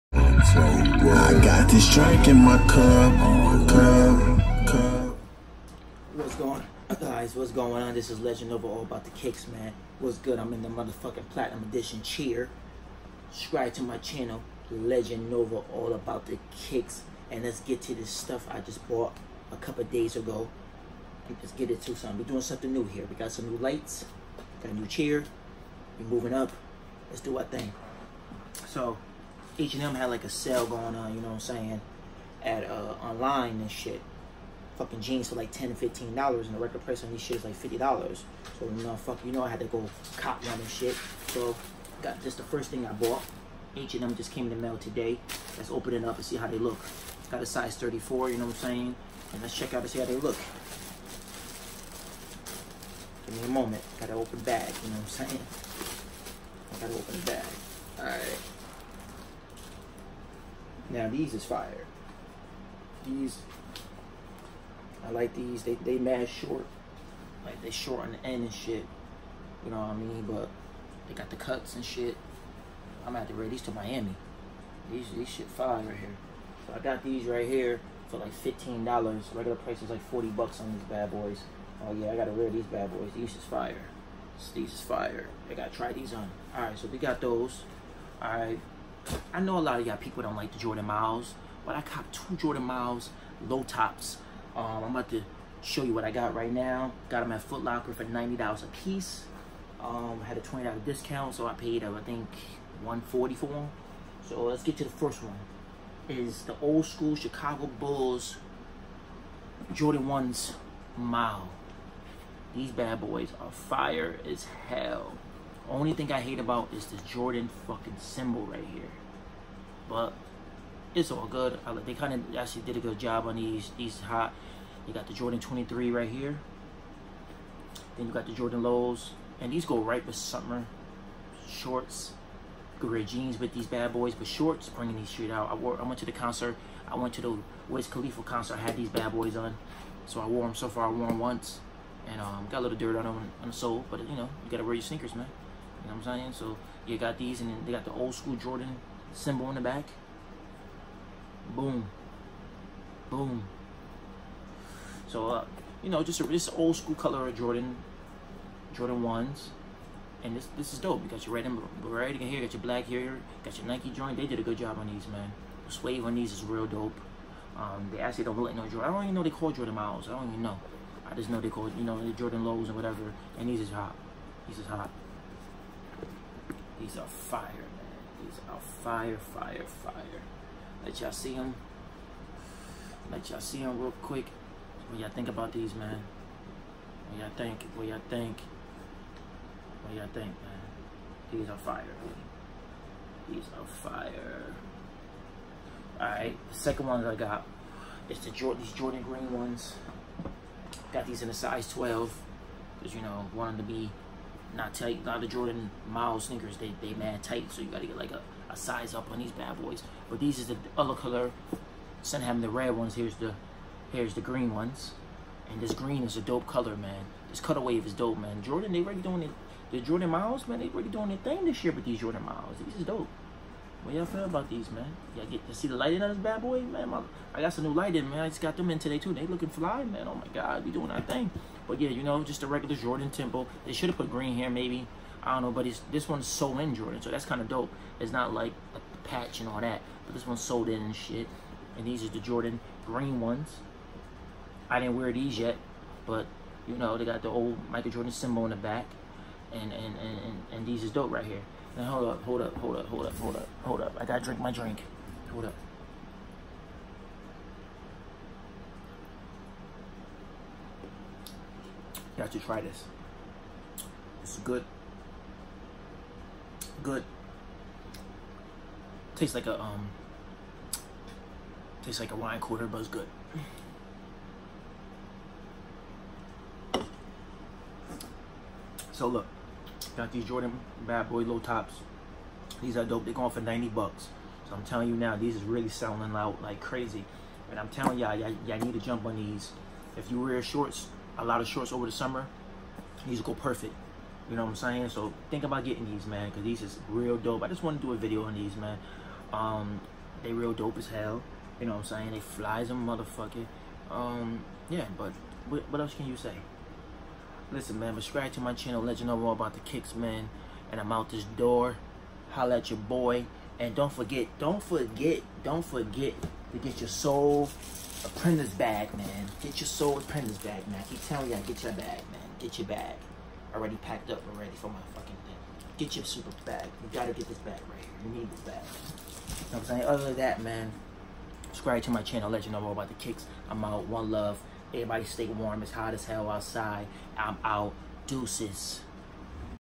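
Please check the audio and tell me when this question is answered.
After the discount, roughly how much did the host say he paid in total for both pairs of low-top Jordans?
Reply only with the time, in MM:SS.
01:42.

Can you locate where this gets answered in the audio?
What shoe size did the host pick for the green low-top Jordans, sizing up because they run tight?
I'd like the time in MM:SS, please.
03:21.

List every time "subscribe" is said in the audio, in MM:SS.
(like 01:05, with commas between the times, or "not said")
00:13, 05:07, 05:31.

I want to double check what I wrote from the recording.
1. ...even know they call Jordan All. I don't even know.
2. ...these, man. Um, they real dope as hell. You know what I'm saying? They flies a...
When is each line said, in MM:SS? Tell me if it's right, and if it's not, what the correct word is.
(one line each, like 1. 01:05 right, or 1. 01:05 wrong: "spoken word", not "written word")
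1. 02:49 wrong: "Miles", not "All"
2. 04:58 right.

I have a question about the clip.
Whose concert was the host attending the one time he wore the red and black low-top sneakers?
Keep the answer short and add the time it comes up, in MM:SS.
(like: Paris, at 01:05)
Wiz Khalifa, at 02:17.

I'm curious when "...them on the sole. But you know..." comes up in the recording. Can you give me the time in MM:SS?
02:23.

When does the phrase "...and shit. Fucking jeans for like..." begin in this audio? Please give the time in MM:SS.
00:33.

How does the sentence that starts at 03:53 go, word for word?
They should have put green here, maybe.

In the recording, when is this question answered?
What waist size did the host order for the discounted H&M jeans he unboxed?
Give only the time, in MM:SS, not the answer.
00:47.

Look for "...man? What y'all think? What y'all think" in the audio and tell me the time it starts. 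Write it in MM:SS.
03:05.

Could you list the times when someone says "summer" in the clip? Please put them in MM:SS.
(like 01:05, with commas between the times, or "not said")
02:10, 04:51.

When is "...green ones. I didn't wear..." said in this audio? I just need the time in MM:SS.
04:02.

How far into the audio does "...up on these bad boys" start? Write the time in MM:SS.
03:28.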